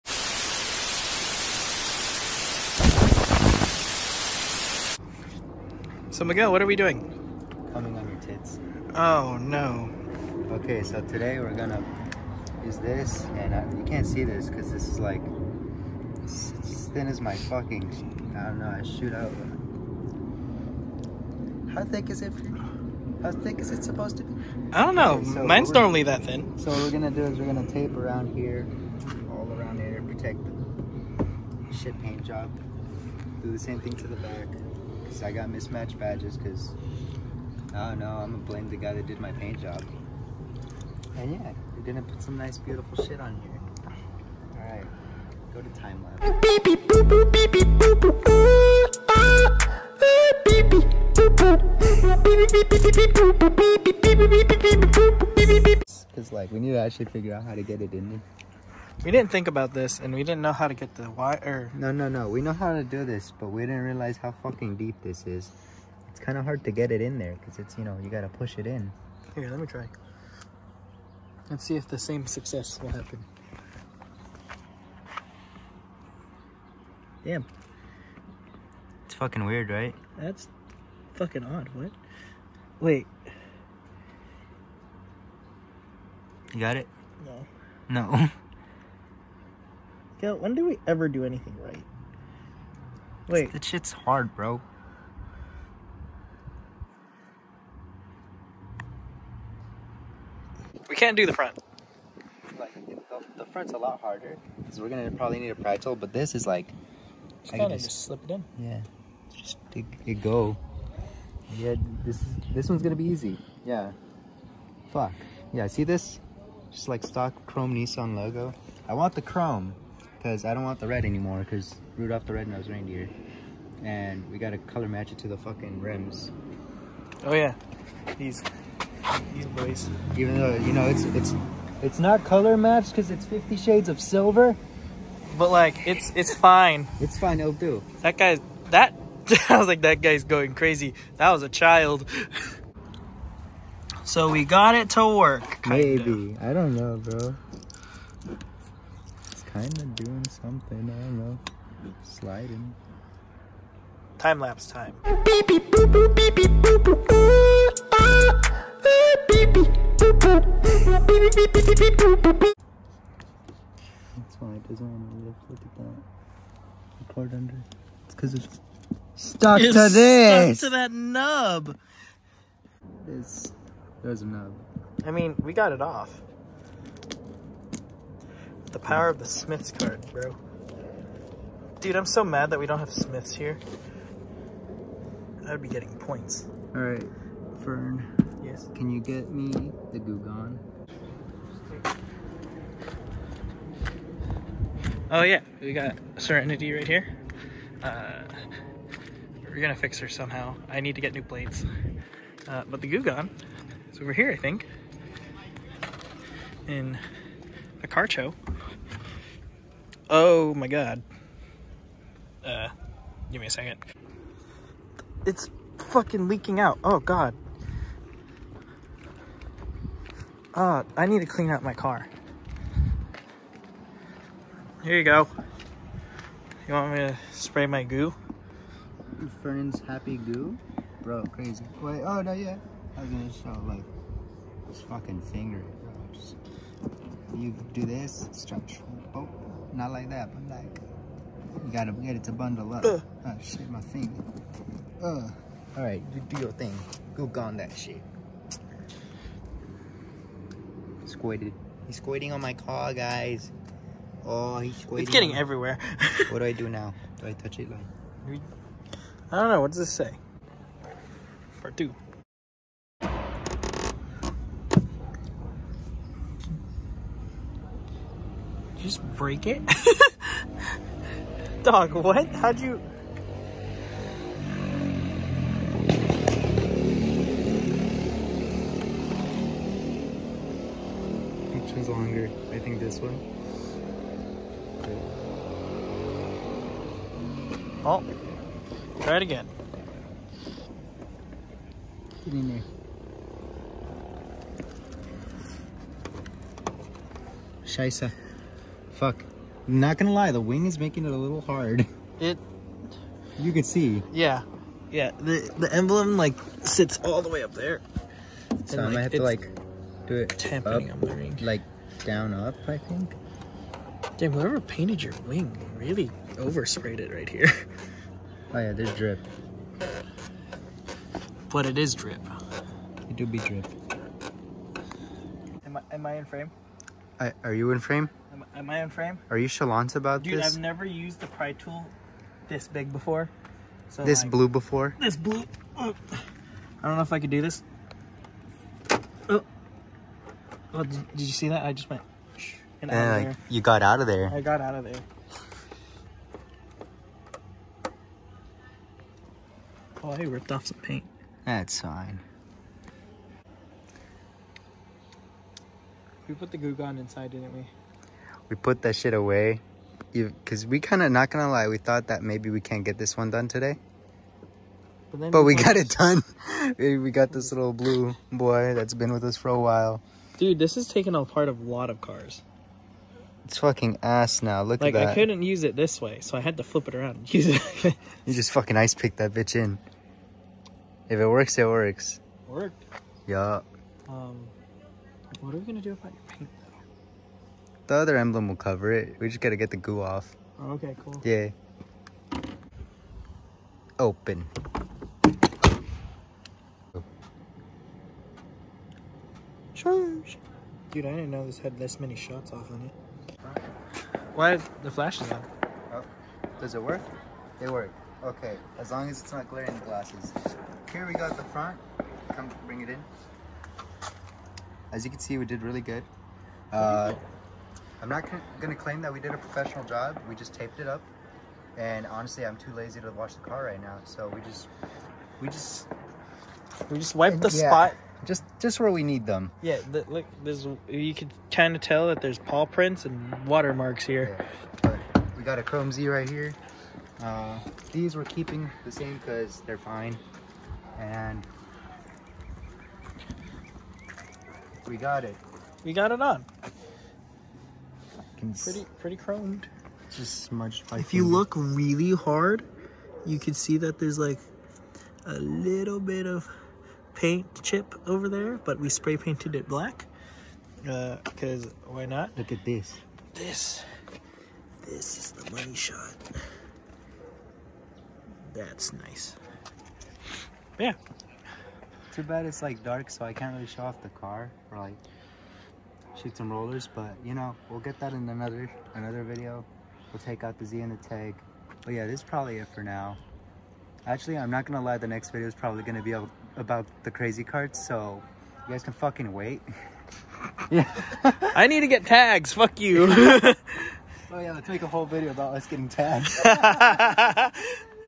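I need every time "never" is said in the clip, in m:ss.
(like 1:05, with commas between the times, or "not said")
5:30.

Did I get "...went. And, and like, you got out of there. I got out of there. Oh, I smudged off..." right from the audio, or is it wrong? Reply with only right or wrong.
wrong.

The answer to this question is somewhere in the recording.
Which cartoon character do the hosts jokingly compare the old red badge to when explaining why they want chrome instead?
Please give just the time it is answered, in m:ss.
2:01.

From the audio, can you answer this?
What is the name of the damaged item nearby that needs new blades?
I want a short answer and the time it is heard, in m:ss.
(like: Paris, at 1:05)
Serenity, at 3:16.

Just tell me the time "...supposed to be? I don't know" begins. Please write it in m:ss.
0:23.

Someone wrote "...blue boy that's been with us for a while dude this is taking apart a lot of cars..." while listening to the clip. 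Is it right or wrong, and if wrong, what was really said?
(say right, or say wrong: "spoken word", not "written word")
right.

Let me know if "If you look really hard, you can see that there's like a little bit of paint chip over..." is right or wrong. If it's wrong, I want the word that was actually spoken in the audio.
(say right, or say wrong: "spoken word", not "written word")
right.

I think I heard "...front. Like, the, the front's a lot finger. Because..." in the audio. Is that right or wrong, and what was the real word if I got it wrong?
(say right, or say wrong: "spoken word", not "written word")
wrong: "harder", not "finger".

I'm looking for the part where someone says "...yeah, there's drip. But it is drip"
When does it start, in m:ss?
5:18.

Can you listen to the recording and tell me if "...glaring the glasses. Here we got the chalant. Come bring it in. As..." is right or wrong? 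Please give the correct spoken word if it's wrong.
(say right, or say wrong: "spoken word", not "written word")
wrong: "front", not "chalant".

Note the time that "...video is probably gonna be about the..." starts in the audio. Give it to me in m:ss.
8:05.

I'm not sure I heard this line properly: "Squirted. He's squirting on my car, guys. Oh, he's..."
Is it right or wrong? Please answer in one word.
right.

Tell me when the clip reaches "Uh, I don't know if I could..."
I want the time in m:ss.
5:35.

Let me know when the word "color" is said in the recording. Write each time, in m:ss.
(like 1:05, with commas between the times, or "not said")
2:04, 2:12.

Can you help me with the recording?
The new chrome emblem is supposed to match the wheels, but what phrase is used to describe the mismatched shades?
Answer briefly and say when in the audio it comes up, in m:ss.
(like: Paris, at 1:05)
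Fifty Shades of Silver, at 2:13.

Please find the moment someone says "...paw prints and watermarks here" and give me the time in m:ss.
7:12.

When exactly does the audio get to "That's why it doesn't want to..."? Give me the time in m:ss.
2:44.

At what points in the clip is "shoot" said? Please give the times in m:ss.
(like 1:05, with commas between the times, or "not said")
0:18, 7:56.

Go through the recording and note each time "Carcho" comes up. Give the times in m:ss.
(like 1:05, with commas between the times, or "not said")
3:27.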